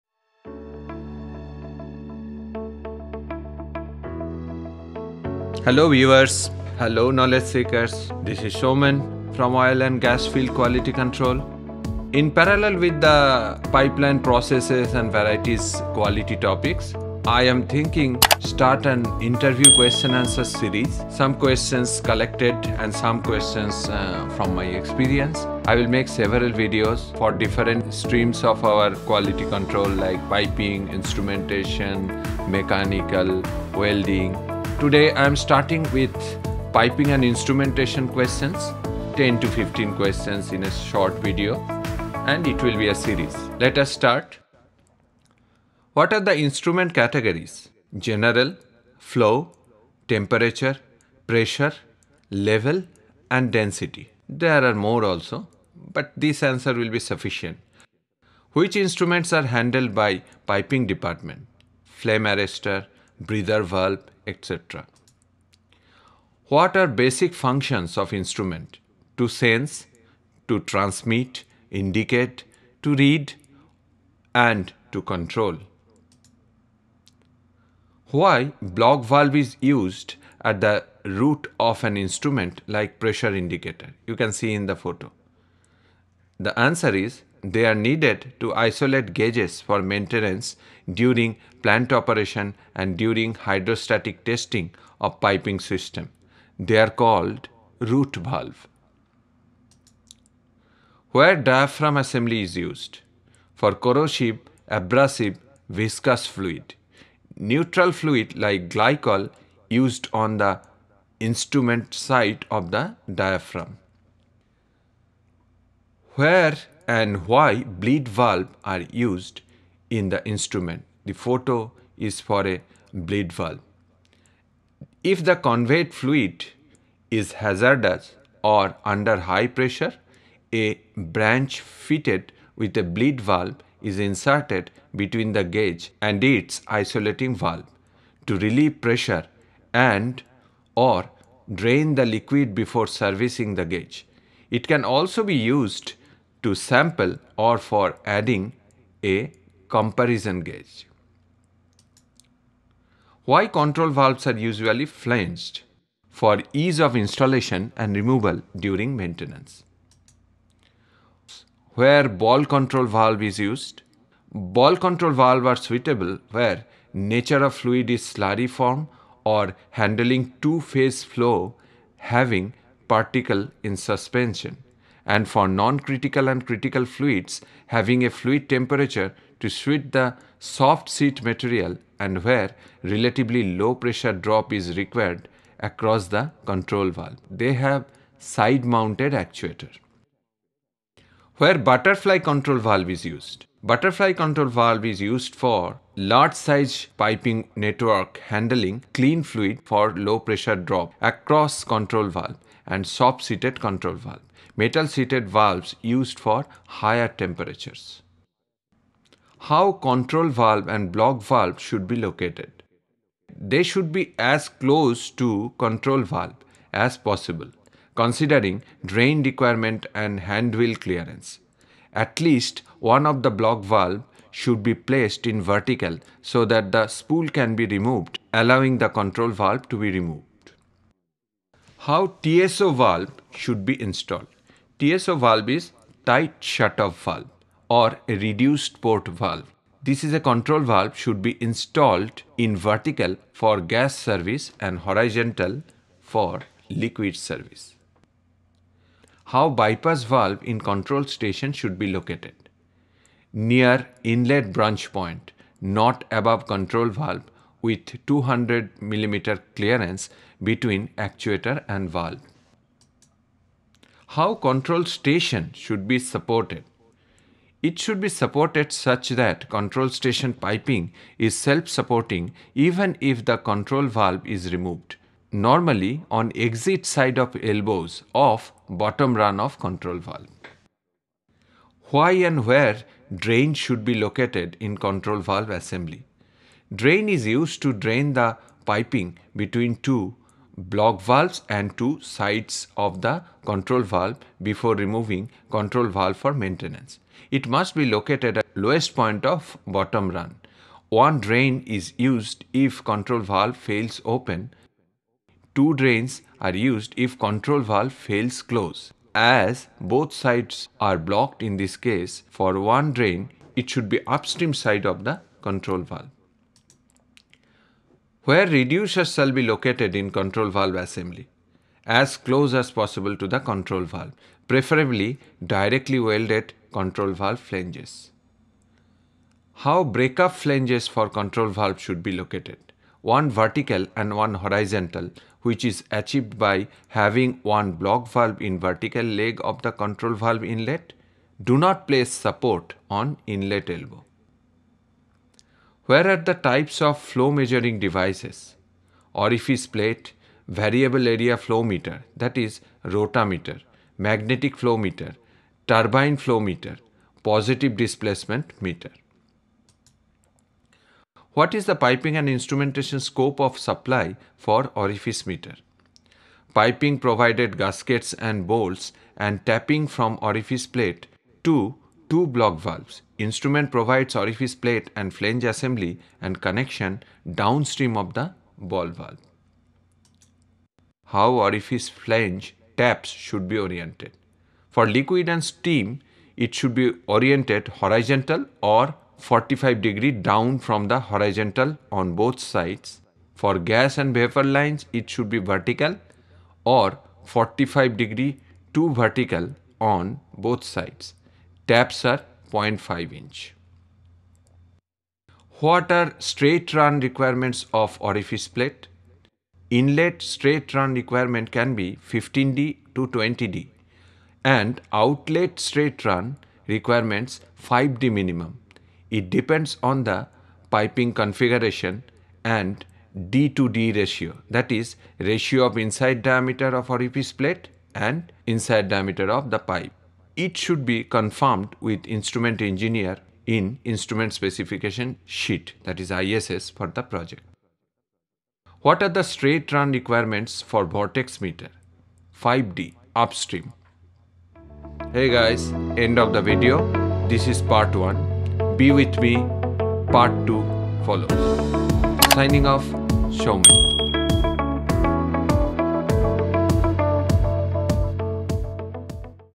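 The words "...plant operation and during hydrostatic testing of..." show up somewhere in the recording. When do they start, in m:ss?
1:31.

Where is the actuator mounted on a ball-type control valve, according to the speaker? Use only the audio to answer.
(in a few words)
Side mounted.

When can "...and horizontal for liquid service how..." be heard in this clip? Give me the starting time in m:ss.
4:04.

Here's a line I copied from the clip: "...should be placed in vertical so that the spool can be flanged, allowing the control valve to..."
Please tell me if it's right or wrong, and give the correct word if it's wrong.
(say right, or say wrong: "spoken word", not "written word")
wrong: "removed", not "flanged".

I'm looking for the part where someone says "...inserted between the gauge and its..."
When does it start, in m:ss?
2:13.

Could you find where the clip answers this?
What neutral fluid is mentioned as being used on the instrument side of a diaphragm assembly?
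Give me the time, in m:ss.
1:48.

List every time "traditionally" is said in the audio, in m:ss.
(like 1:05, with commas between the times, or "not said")
not said.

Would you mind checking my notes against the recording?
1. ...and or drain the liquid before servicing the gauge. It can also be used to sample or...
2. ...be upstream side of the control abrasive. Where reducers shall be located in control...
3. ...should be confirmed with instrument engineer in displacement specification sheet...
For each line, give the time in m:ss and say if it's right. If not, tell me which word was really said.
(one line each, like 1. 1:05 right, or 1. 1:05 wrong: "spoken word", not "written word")
1. 2:19 right
2. 5:13 wrong: "valve", not "abrasive"
3. 7:10 wrong: "instrument", not "displacement".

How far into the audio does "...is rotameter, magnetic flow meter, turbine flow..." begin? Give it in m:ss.
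5:52.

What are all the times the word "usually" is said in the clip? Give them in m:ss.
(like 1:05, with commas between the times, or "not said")
2:34.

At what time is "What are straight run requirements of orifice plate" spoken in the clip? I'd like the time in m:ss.
6:45.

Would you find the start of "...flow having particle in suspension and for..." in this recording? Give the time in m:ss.
2:51.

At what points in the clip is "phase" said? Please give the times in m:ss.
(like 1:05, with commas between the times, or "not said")
2:50.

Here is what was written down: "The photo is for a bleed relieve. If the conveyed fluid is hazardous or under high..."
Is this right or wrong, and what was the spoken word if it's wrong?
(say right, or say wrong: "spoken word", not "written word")
wrong: "valve", not "relieve".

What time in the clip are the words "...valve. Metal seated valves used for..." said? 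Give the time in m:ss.
3:23.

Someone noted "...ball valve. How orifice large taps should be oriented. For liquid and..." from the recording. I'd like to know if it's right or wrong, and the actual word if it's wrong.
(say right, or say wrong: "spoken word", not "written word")
wrong: "flange", not "large".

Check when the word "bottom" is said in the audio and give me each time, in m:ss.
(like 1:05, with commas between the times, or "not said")
4:38, 4:59.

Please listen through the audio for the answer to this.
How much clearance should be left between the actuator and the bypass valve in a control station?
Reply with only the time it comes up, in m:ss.
4:18.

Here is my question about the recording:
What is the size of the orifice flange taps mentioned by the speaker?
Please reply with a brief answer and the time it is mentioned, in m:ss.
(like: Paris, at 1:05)
0.5 inch, at 6:42.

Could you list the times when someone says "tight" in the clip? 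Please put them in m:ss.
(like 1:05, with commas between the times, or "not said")
3:56.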